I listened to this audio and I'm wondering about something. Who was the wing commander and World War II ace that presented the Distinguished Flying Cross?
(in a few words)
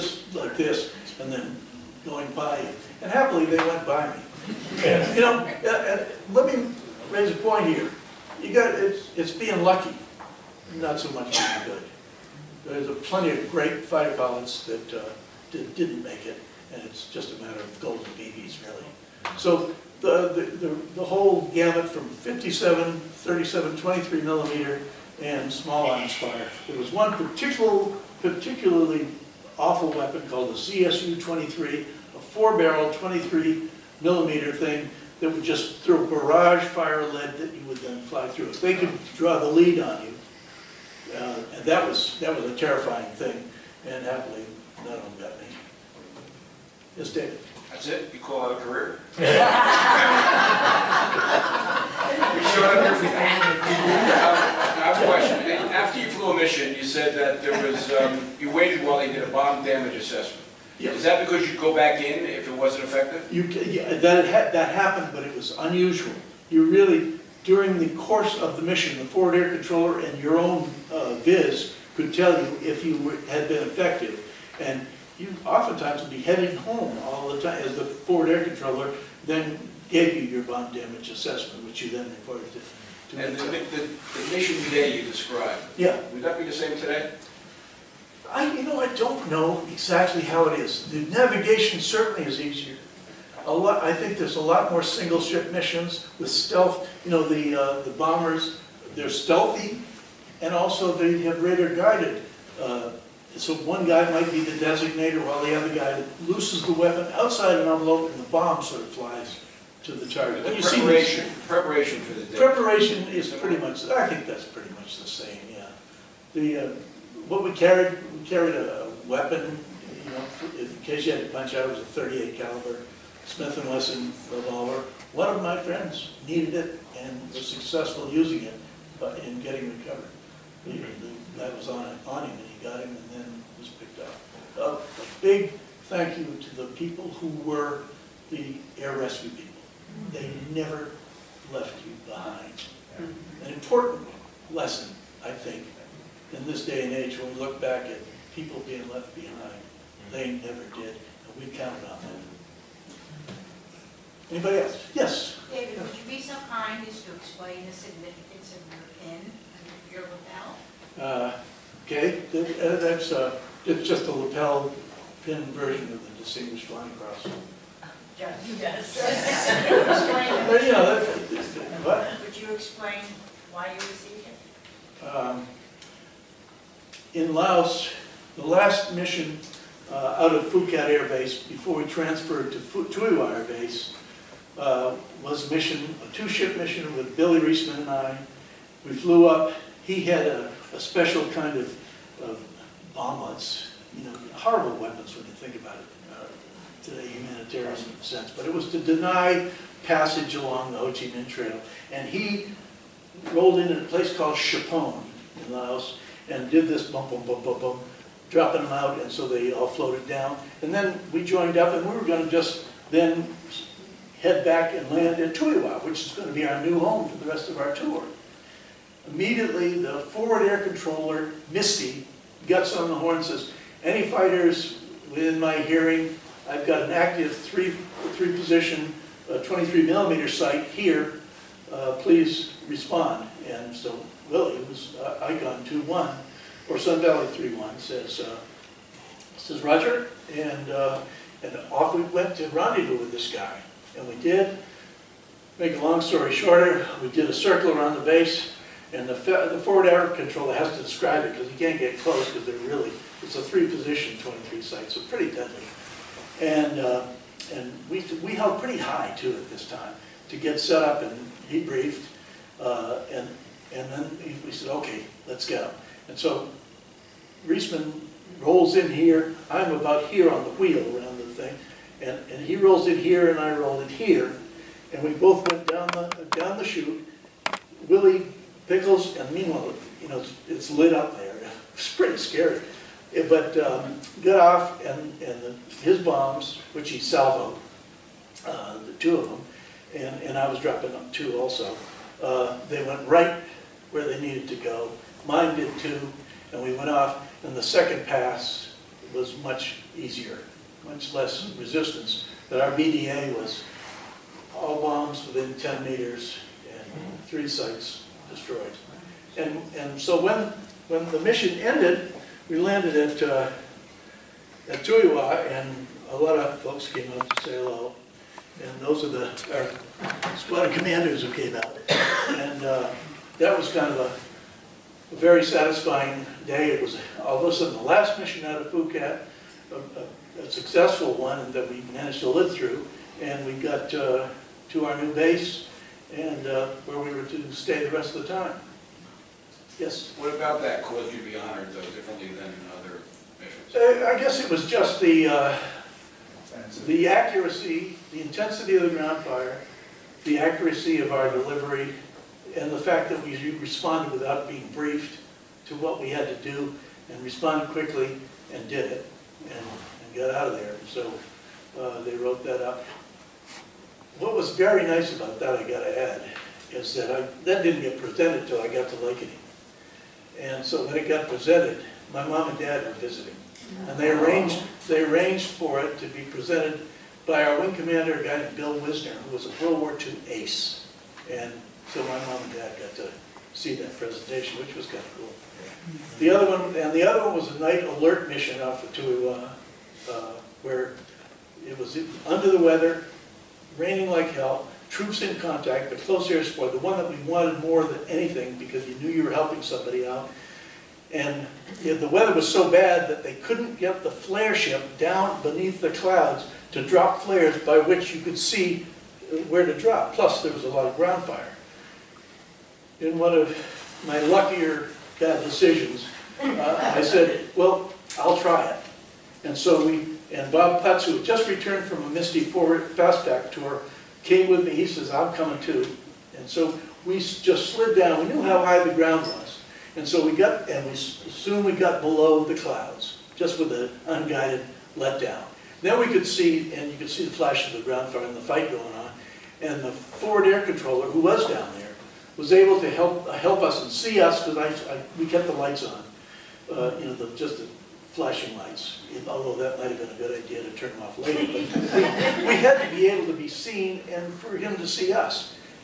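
Bill Wisner.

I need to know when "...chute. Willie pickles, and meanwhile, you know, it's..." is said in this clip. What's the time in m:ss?
4:36.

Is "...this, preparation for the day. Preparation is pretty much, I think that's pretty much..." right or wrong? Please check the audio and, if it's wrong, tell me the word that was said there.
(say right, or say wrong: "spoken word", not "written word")
right.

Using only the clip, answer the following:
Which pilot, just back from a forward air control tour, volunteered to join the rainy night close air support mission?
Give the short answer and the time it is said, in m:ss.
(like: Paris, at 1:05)
Bob Putz, at 7:00.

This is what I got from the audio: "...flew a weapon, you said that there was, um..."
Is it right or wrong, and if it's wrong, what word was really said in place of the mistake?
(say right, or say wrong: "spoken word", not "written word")
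wrong: "mission", not "weapon".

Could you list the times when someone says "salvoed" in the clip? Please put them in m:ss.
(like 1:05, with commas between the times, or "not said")
4:46.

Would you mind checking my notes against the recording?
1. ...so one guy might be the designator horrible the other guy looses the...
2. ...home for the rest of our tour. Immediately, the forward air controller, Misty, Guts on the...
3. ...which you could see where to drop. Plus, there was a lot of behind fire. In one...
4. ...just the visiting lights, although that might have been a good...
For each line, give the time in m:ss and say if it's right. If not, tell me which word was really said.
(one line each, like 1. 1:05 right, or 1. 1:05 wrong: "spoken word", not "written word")
1. 1:43 wrong: "while", not "horrible"
2. 3:36 right
3. 6:47 wrong: "ground", not "behind"
4. 7:27 wrong: "flashing", not "visiting".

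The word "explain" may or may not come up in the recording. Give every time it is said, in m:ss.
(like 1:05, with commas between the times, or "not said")
2:37, 2:52.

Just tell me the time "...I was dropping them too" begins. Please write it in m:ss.
4:50.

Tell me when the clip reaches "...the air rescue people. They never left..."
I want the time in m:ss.
2:18.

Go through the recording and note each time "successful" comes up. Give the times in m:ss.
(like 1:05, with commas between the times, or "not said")
2:07, 5:30.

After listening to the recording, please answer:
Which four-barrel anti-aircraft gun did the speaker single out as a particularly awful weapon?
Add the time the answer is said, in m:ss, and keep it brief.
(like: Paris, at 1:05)
ZSU-23, at 0:30.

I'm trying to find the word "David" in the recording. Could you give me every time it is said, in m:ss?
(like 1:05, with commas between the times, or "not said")
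0:47, 2:35.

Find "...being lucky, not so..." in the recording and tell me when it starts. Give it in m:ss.
0:09.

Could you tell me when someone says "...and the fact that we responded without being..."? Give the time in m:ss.
5:52.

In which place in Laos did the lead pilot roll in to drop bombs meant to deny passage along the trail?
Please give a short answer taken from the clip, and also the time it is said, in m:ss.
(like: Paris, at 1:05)
Tchepone, at 3:24.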